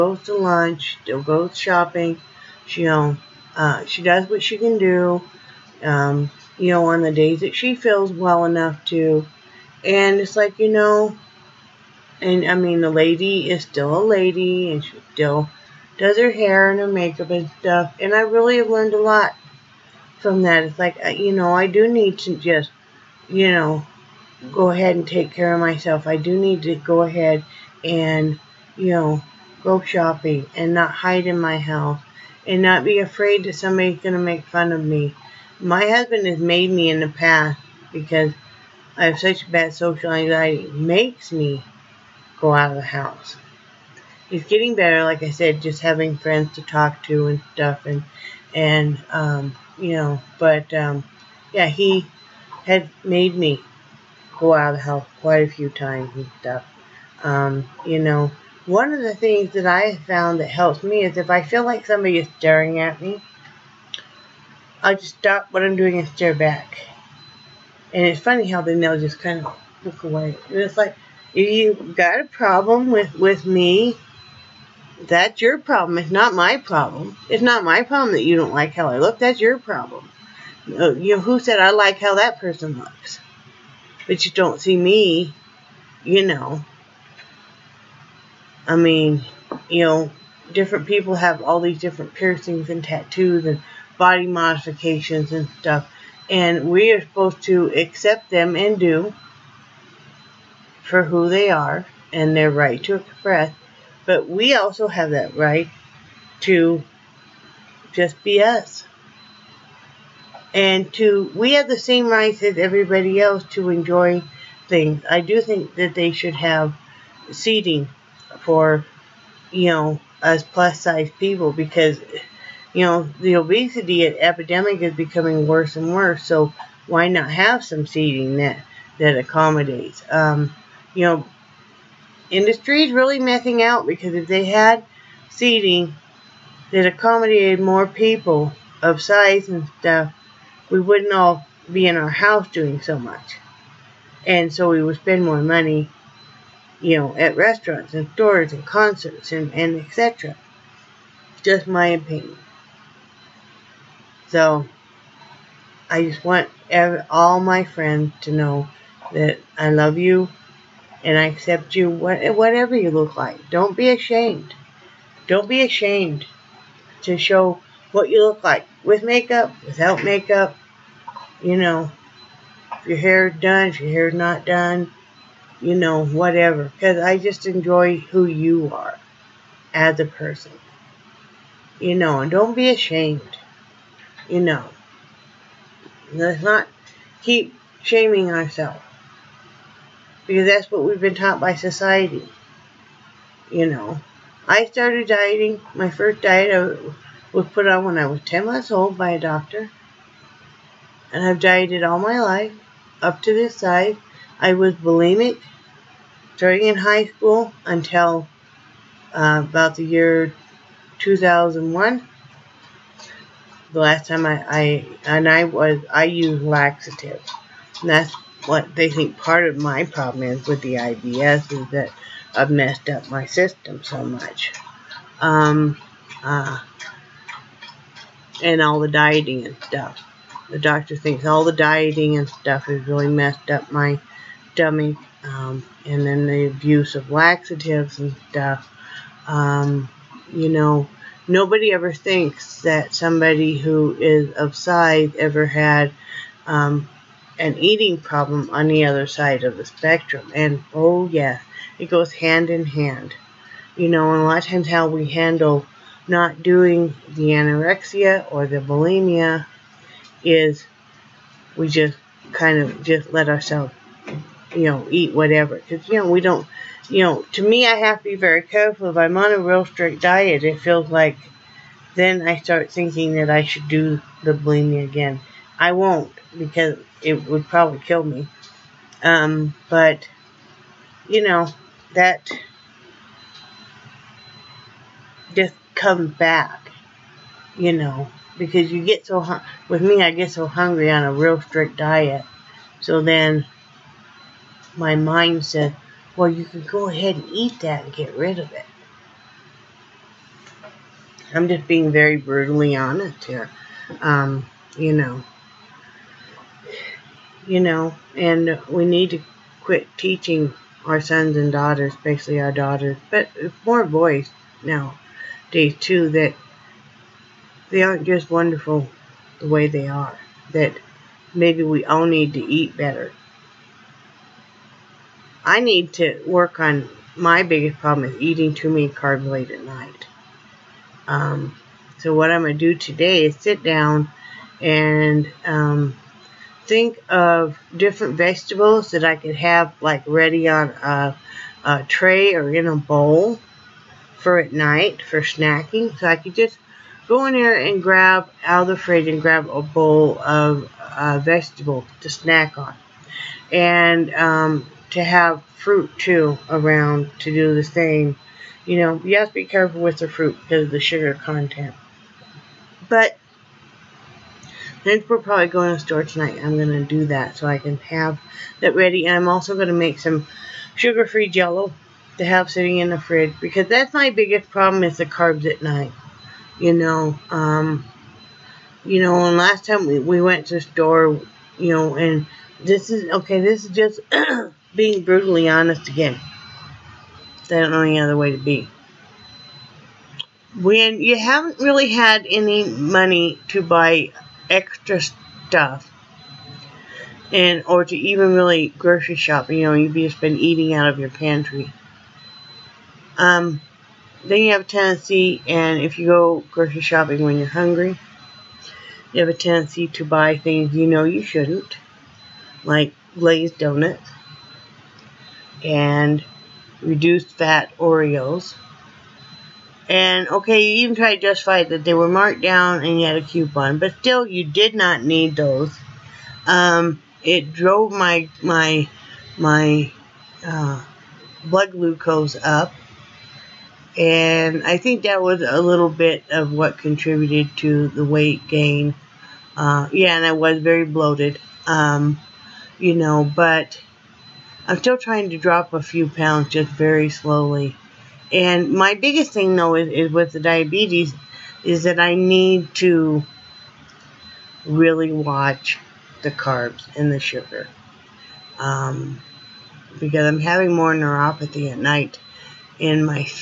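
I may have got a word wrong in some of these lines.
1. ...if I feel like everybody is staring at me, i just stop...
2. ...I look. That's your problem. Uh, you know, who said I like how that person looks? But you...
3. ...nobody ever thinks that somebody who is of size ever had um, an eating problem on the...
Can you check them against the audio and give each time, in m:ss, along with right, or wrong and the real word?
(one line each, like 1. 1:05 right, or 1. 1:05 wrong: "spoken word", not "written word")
1. 1:01 wrong: "somebody", not "everybody"
2. 1:18 right
3. 4:01 right.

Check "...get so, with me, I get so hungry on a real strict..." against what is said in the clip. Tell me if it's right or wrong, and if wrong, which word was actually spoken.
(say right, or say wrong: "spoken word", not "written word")
right.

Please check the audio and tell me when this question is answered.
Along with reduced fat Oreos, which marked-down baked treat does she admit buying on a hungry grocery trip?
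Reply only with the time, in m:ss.
6:53.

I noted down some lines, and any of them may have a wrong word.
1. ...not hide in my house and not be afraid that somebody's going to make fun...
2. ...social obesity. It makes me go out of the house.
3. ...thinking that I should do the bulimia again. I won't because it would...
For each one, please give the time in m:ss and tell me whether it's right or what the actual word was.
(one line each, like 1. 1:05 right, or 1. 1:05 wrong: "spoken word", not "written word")
1. 0:30 right
2. 0:39 wrong: "anxiety", not "obesity"
3. 4:32 right.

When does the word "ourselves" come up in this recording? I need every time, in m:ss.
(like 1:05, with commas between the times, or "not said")
3:08, 4:23.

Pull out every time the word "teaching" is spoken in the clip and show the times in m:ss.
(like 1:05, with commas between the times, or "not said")
5:09.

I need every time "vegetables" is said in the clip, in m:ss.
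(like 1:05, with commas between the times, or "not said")
5:38, 5:51.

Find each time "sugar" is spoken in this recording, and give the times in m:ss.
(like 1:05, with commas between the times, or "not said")
6:00, 6:10, 7:37.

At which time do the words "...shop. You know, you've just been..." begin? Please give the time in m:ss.
6:39.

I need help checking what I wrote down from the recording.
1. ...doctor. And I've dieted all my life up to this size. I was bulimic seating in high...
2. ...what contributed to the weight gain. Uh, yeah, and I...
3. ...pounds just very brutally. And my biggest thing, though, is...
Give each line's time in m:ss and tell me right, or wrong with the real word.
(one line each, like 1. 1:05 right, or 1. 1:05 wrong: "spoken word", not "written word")
1. 3:19 wrong: "starting", not "seating"
2. 7:16 right
3. 7:26 wrong: "slowly", not "brutally".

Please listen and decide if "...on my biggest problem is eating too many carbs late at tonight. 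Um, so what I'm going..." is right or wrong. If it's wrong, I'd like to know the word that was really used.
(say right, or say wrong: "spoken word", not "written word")
wrong: "night", not "tonight".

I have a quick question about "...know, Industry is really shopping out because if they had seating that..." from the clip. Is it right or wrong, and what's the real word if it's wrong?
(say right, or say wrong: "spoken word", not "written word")
wrong: "missing", not "shopping".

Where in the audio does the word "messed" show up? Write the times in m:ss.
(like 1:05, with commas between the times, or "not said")
3:42, 3:53.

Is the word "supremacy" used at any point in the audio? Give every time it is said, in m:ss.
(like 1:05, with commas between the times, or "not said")
not said.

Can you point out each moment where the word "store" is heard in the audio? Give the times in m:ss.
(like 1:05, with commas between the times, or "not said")
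2:28, 6:05, 6:20.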